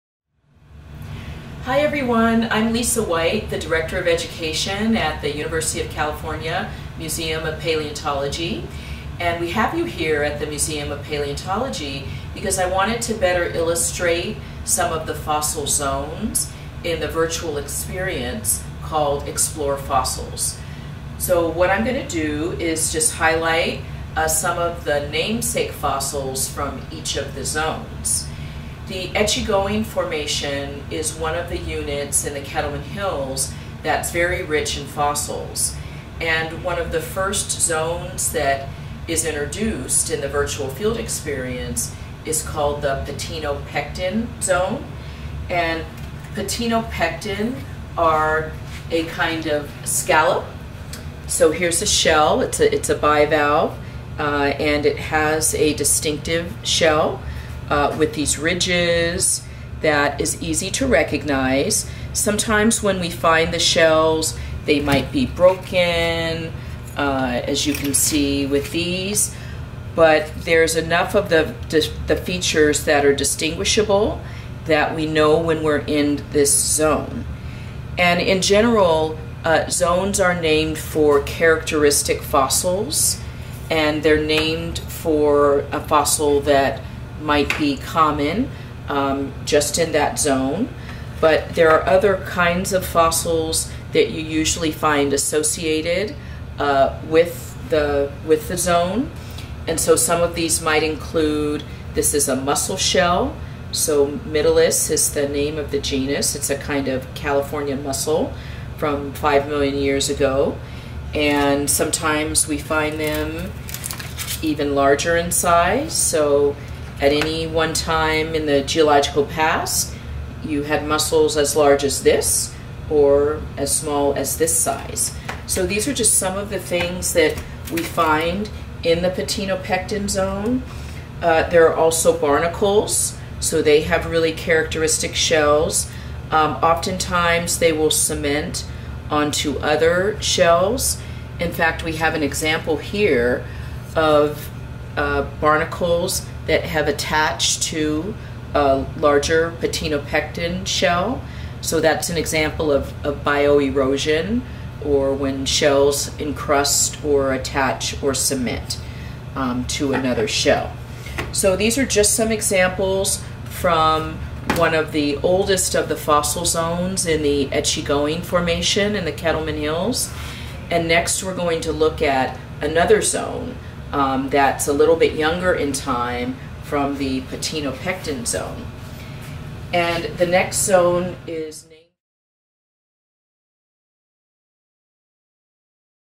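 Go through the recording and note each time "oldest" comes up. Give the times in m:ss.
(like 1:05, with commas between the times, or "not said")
2:45.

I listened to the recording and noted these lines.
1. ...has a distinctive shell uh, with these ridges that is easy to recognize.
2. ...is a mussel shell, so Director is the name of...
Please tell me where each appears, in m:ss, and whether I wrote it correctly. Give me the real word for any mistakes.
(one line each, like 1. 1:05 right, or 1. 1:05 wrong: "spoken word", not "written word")
1. 0:54 right
2. 1:42 wrong: "Mytilus", not "Director".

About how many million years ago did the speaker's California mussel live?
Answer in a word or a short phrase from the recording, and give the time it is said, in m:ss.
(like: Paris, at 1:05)
5 million years, at 1:49.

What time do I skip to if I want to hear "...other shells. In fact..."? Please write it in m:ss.
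2:19.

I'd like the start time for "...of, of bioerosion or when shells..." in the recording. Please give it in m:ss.
2:32.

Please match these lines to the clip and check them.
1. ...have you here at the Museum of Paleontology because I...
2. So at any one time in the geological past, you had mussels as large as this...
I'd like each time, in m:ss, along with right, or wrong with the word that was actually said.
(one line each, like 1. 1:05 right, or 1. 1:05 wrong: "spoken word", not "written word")
1. 0:09 right
2. 1:55 right.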